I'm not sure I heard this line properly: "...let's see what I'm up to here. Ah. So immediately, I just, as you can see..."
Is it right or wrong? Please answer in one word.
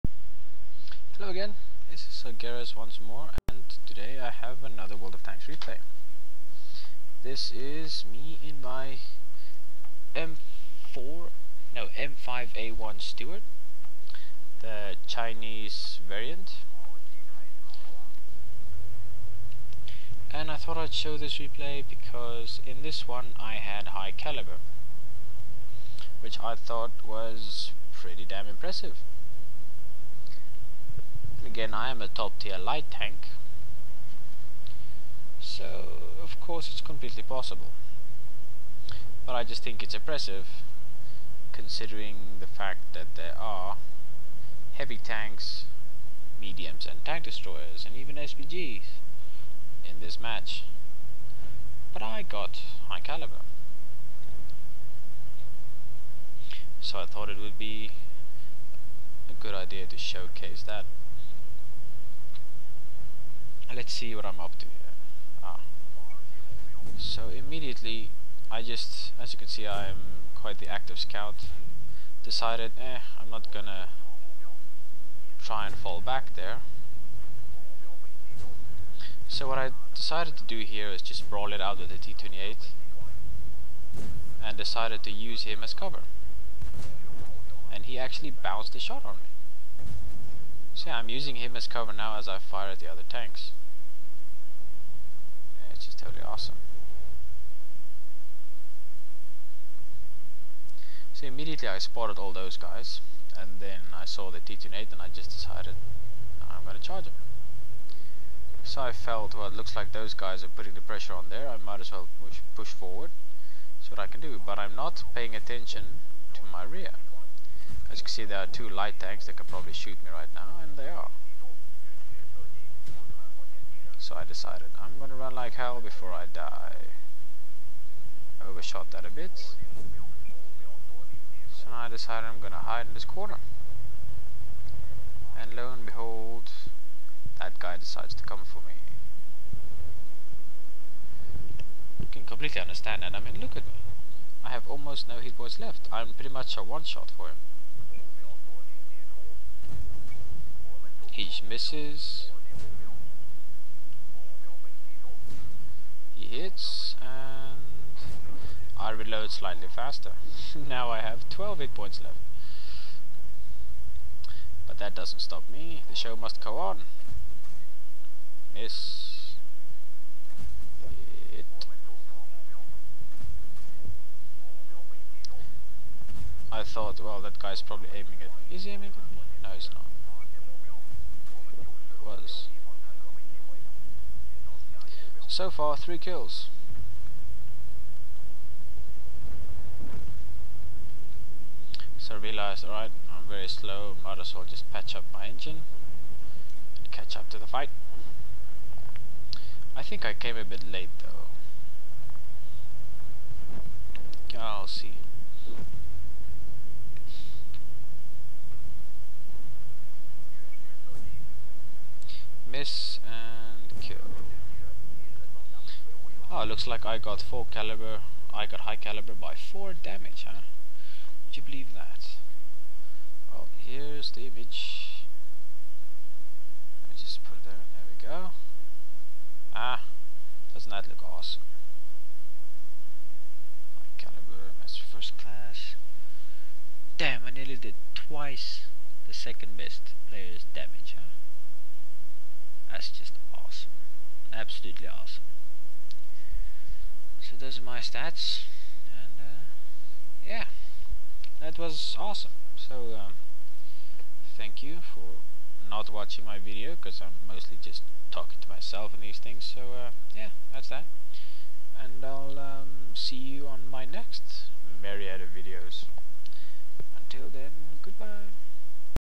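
right.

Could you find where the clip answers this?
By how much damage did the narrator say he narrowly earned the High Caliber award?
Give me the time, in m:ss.
3:39.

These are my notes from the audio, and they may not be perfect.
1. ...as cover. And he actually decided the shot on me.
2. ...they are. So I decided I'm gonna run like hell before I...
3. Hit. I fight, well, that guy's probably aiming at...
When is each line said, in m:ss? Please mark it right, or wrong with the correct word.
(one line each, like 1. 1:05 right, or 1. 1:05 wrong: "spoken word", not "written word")
1. 1:25 wrong: "bounced", not "decided"
2. 2:00 right
3. 2:51 wrong: "thought", not "fight".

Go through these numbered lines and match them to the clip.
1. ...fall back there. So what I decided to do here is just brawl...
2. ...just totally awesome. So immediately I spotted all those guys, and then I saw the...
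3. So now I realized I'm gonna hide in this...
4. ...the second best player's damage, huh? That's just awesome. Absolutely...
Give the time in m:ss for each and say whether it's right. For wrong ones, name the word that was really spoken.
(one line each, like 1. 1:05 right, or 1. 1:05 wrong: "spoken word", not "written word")
1. 1:15 right
2. 1:35 right
3. 2:11 wrong: "decided", not "realized"
4. 3:59 right.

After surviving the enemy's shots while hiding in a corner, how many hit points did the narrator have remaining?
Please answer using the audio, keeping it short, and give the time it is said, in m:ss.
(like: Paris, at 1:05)
12, at 2:41.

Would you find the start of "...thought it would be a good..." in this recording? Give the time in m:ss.
0:57.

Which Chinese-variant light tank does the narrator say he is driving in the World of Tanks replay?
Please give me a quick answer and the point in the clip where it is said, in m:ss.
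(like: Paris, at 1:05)
M5A1 Stuart, at 0:11.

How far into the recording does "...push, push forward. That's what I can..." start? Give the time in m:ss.
1:52.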